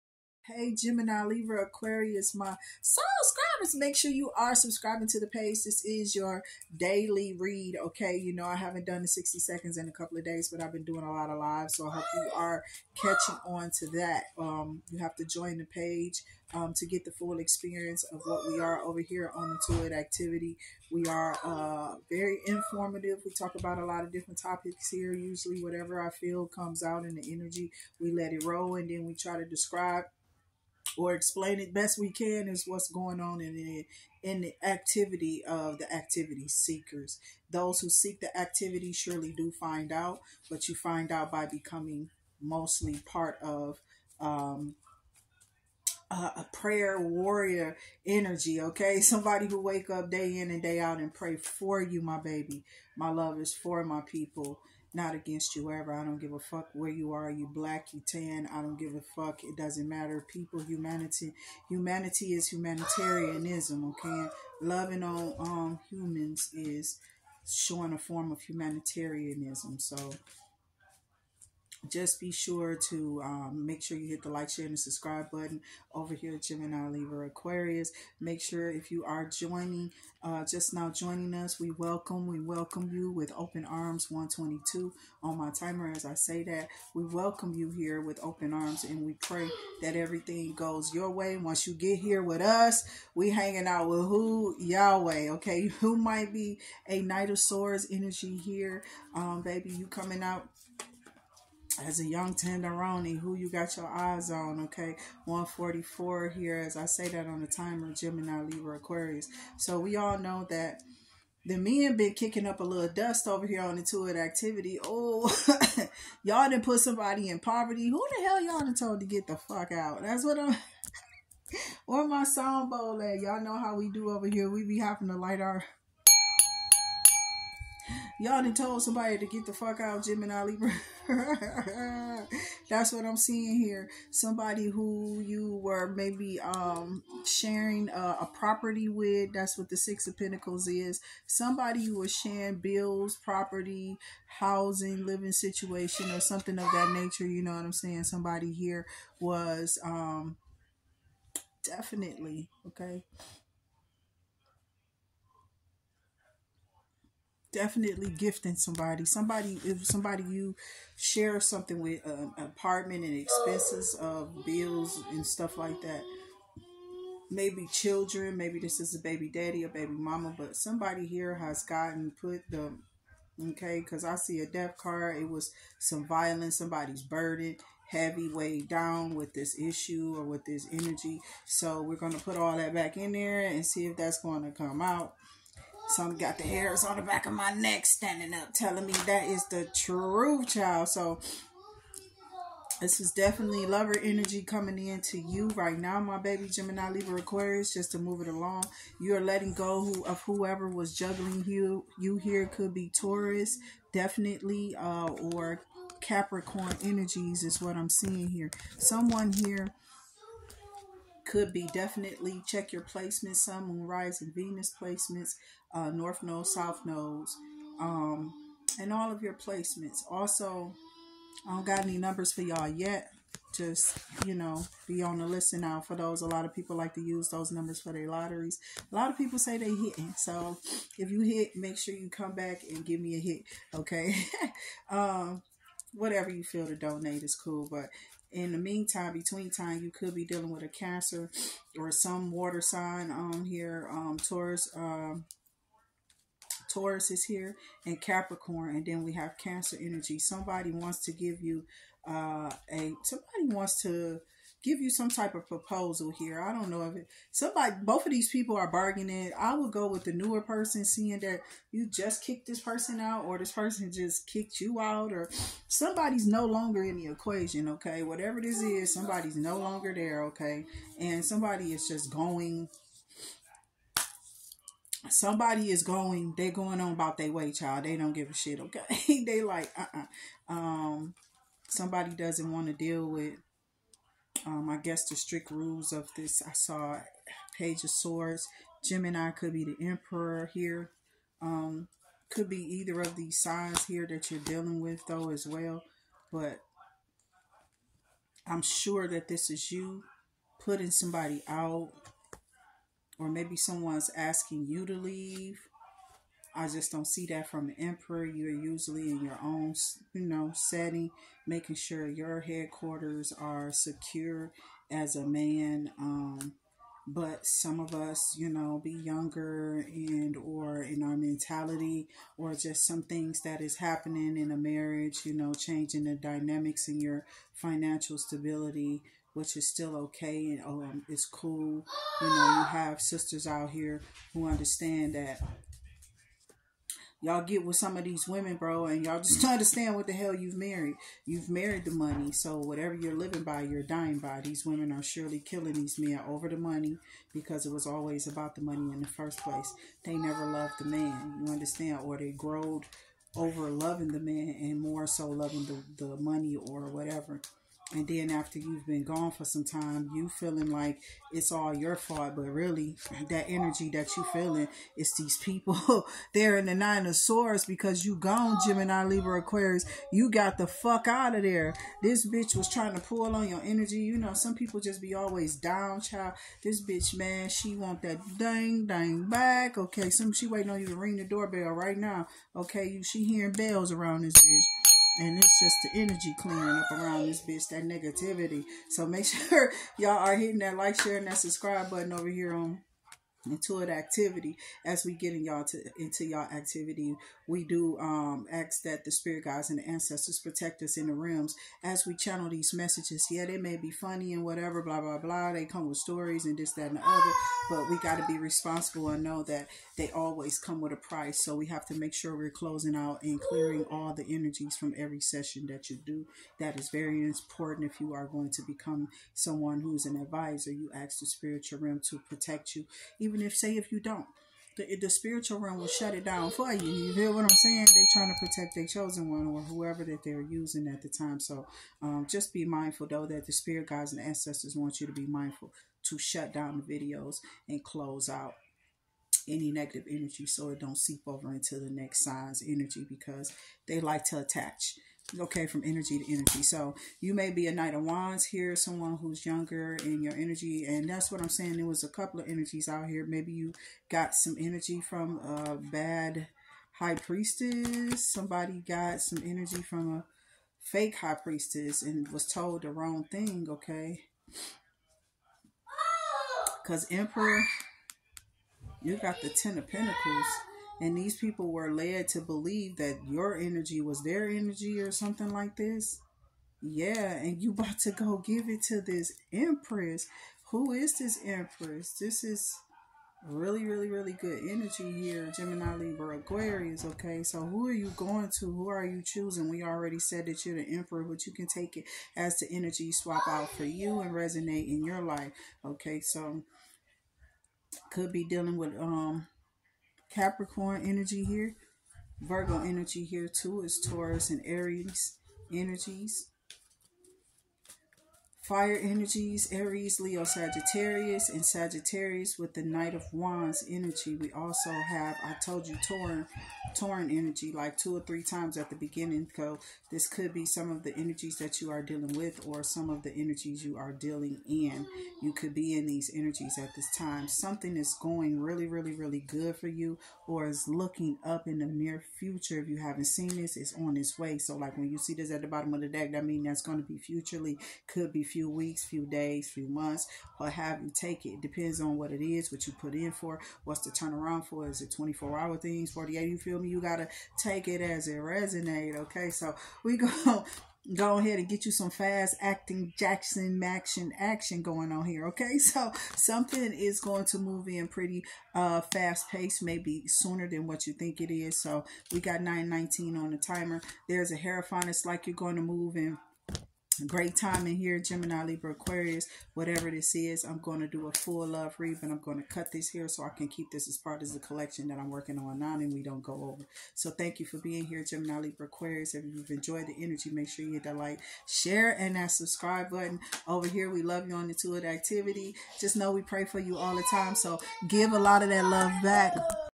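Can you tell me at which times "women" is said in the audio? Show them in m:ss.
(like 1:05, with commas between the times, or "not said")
5:38, 5:44.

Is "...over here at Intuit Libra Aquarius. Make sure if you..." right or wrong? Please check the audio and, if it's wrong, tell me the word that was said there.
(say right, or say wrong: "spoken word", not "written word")
wrong: "Gemini", not "Intuit".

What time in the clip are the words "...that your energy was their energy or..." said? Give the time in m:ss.
7:52.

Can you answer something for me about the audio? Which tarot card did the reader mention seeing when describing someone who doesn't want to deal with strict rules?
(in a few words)
Page of Swords.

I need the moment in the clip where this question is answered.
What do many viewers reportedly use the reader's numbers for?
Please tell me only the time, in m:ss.
3:48.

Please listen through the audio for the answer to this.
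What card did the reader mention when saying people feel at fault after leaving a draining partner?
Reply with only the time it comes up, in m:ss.
6:06.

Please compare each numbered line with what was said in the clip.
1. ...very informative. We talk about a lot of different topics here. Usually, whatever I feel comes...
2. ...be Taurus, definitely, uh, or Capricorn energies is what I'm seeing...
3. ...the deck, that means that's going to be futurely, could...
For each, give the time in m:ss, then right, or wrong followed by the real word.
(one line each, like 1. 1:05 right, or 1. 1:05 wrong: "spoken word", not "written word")
1. 0:22 right
2. 3:22 right
3. 8:56 right.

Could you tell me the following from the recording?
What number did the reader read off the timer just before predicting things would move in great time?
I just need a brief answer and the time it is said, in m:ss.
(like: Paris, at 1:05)
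919, at 9:22.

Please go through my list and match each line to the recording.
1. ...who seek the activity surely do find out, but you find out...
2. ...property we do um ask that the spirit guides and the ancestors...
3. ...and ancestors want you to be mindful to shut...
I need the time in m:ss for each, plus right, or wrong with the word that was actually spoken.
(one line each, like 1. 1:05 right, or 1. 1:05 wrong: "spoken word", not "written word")
1. 0:37 right
2. 6:36 wrong: "activity", not "property"
3. 7:14 right.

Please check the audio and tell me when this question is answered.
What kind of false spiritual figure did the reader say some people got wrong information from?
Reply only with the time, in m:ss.
7:40.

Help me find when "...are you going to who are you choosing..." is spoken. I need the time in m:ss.
8:07.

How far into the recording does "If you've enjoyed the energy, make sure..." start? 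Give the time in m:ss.
9:39.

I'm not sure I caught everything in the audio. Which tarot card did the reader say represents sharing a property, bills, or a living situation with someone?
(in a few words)
Six of Pentacles.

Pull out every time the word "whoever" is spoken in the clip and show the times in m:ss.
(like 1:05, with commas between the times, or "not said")
3:20, 7:09.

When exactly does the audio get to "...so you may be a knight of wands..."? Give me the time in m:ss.
7:26.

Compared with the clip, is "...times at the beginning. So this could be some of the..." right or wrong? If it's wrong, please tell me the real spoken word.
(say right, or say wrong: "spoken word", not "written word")
right.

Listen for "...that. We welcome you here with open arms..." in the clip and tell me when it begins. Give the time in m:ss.
1:26.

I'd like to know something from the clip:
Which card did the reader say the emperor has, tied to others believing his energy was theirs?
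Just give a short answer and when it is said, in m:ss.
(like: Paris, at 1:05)
Ten of Pentacles, at 7:49.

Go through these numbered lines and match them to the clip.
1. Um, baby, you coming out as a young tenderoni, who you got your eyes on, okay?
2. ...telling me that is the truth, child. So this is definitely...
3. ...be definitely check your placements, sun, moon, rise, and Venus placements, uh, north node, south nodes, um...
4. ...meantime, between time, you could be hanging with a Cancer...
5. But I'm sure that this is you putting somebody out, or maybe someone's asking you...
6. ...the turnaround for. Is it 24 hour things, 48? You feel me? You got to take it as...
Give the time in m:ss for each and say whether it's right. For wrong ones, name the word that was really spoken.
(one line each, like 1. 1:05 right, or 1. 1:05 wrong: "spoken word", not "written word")
1. 1:39 right
2. 3:08 right
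3. 3:31 right
4. 3:58 wrong: "dealing", not "hanging"
5. 4:56 right
6. 9:04 right.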